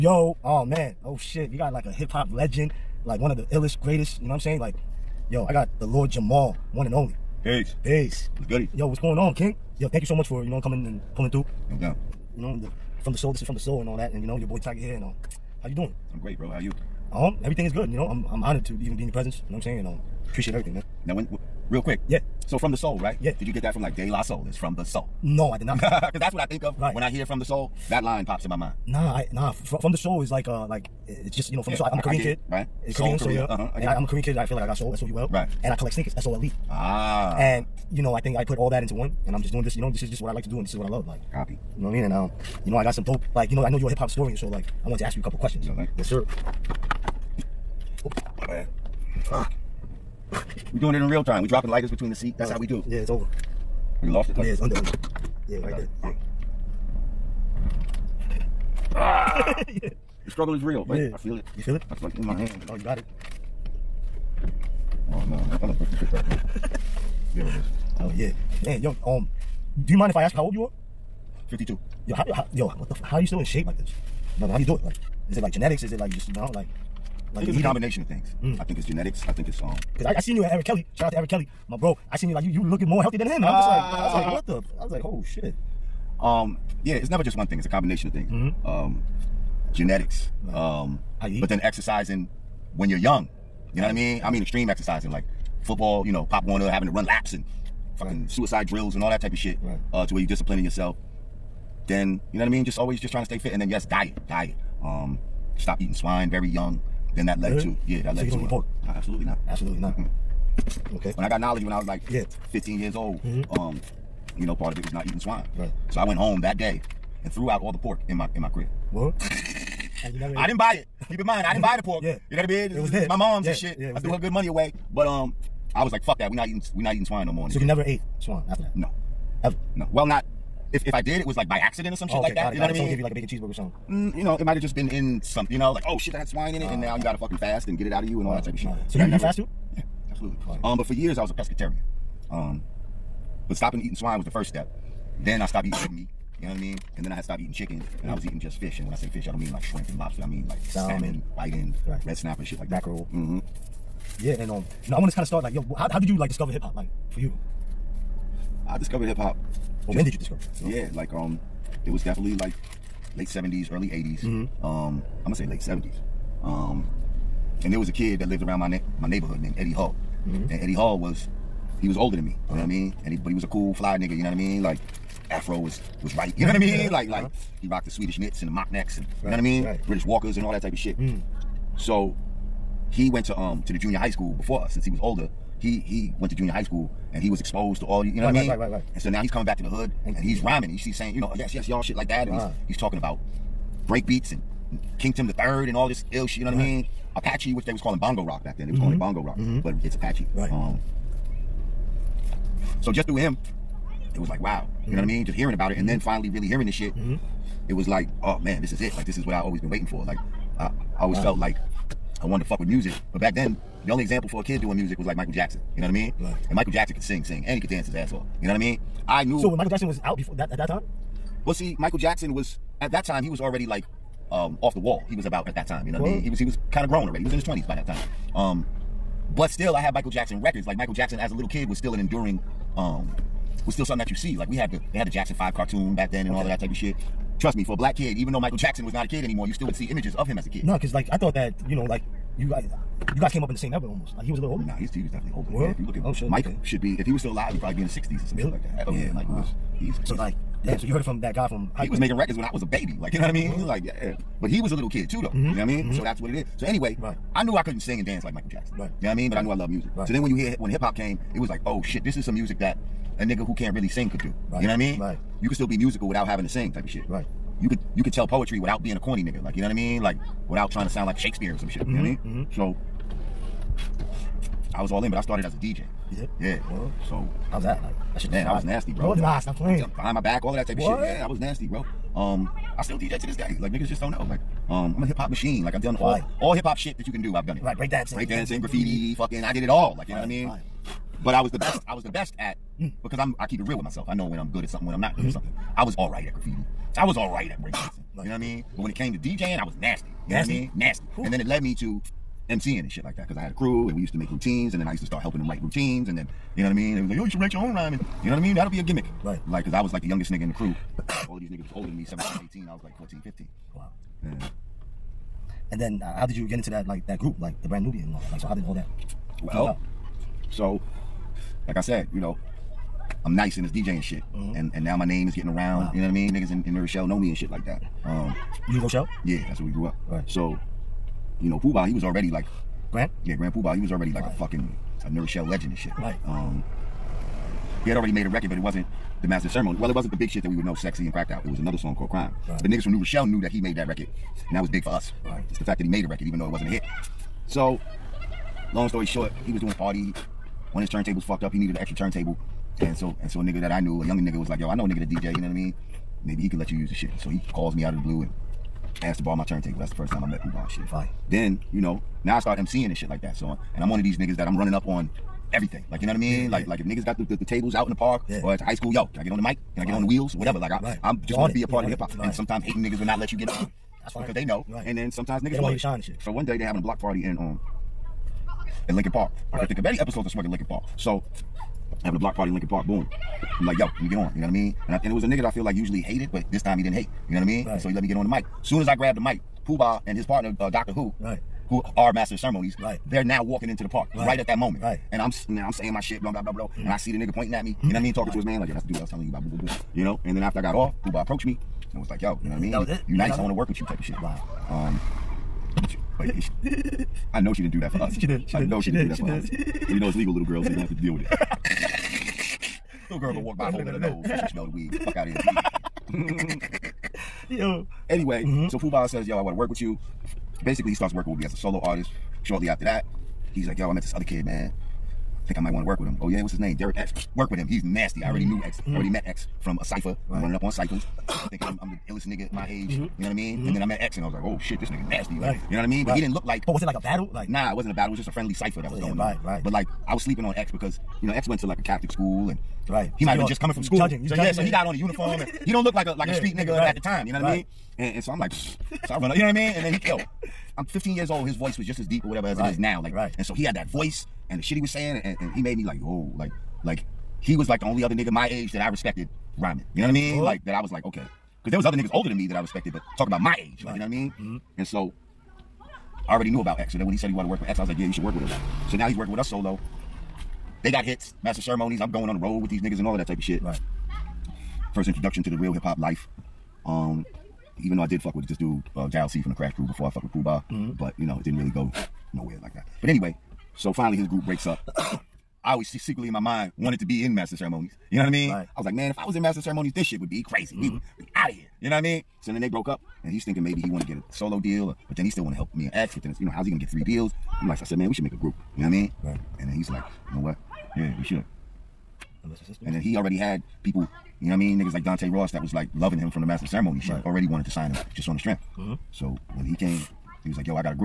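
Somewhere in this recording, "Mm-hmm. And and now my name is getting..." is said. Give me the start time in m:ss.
5:24.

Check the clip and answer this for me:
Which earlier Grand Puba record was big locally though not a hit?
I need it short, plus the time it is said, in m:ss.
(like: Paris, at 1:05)
Crime, at 5:42.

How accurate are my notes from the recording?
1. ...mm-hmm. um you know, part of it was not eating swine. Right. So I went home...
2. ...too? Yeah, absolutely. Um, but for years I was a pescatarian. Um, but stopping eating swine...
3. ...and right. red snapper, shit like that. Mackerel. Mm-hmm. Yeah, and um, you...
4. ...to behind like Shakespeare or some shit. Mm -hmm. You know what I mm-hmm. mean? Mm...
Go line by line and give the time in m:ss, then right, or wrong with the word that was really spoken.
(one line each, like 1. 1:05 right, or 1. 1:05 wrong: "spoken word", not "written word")
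1. 1:53 right
2. 2:19 right
3. 2:31 right
4. 4:30 wrong: "sound", not "behind".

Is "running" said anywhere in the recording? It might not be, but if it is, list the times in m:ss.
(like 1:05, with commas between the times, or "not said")
6:04, 7:10.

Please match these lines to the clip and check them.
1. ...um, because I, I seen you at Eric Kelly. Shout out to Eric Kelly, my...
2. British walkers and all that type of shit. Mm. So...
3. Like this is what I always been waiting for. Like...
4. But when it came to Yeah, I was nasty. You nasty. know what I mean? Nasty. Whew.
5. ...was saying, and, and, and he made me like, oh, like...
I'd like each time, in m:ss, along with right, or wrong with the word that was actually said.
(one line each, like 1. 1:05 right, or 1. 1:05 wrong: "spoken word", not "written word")
1. 1:19 right
2. 2:59 right
3. 3:28 right
4. 4:58 wrong: "DJing", not "Yeah"
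5. 7:34 right.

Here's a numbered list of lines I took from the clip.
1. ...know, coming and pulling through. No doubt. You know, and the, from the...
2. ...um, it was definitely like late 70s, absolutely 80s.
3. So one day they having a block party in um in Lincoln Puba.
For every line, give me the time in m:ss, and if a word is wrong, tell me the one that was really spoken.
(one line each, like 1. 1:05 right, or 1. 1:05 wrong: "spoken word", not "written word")
1. 0:10 right
2. 2:41 wrong: "early", not "absolutely"
3. 6:16 wrong: "Park", not "Puba".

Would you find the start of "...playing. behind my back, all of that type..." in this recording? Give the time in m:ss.
4:39.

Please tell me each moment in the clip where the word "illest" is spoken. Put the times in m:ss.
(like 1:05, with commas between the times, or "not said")
0:03, 7:12.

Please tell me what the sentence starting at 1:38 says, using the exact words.
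suicide drills and all that type of shit right.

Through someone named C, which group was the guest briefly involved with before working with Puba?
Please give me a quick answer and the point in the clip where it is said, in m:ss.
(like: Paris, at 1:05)
Crash Crew, at 7:59.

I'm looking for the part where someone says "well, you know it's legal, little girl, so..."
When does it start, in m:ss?
6:49.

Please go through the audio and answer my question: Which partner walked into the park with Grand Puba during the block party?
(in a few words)
Doctor Who.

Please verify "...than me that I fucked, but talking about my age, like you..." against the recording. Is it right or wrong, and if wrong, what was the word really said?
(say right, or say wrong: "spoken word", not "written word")
wrong: "respected", not "fucked".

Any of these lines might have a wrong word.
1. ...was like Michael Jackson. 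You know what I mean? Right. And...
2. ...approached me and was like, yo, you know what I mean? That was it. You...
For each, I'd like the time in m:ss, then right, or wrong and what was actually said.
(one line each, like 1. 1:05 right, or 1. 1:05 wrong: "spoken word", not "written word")
1. 3:34 right
2. 6:41 right.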